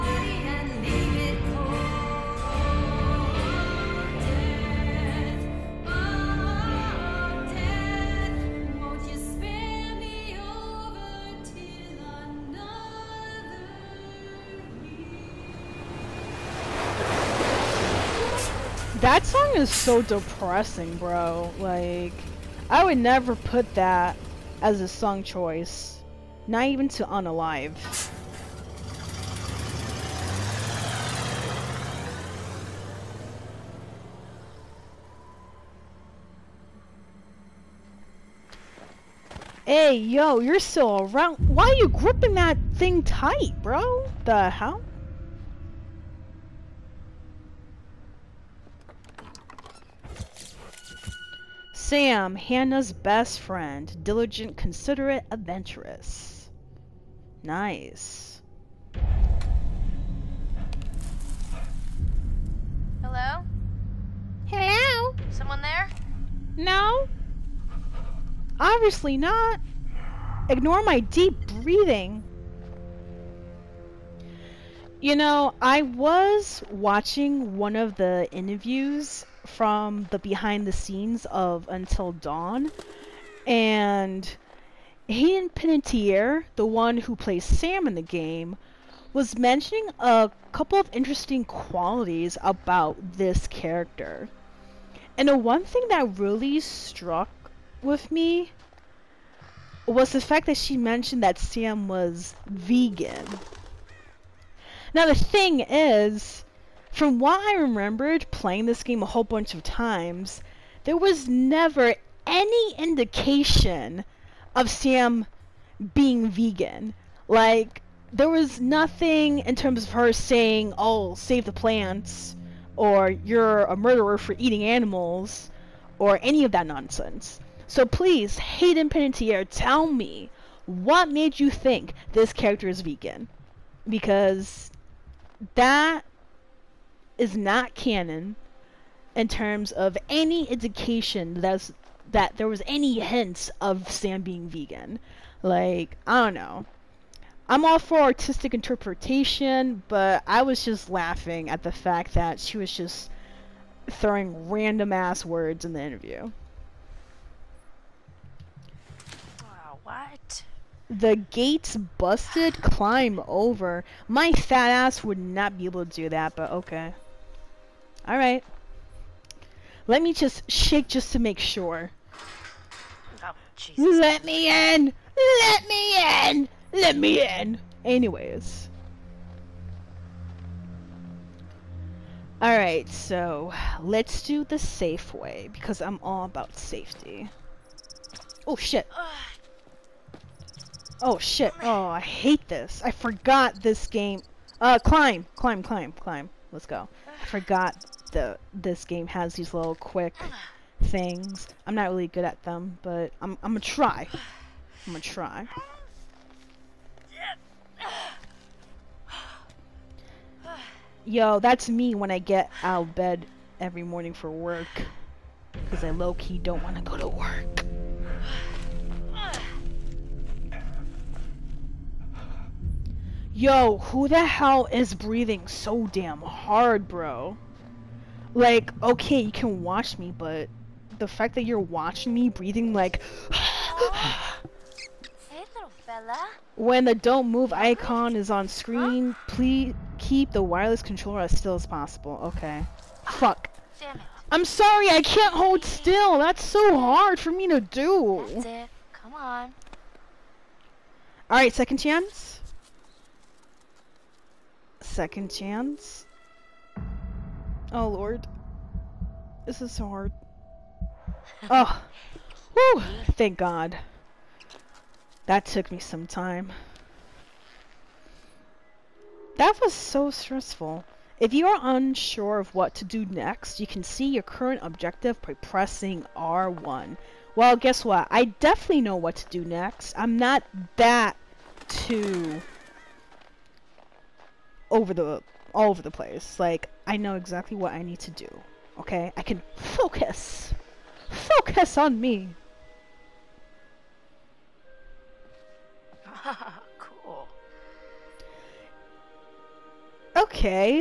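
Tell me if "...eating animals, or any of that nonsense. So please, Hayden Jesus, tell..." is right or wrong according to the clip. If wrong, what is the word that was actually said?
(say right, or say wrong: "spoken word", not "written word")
wrong: "Panettiere", not "Jesus".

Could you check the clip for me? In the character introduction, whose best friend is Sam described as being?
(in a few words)
Hannah.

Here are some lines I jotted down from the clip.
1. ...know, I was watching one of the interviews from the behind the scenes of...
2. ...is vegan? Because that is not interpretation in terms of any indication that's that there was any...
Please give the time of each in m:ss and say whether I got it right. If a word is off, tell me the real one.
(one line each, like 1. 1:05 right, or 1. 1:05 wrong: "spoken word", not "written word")
1. 1:15 right
2. 2:12 wrong: "canon", not "interpretation".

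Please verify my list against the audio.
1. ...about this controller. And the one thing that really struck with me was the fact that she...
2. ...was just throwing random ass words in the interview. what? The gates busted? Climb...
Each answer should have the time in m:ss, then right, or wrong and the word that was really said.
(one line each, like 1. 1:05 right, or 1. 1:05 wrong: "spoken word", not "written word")
1. 1:32 wrong: "character", not "controller"
2. 2:32 right.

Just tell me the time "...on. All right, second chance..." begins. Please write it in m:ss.
4:09.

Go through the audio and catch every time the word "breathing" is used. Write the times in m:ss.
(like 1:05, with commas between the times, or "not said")
1:11, 3:44, 3:52.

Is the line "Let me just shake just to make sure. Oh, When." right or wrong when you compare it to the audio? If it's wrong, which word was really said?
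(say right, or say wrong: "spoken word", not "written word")
wrong: "Jesus", not "When".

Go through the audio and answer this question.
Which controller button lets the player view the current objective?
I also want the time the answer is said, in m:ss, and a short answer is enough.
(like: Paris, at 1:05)
R1, at 4:36.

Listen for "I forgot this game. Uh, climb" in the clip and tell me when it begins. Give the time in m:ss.
3:12.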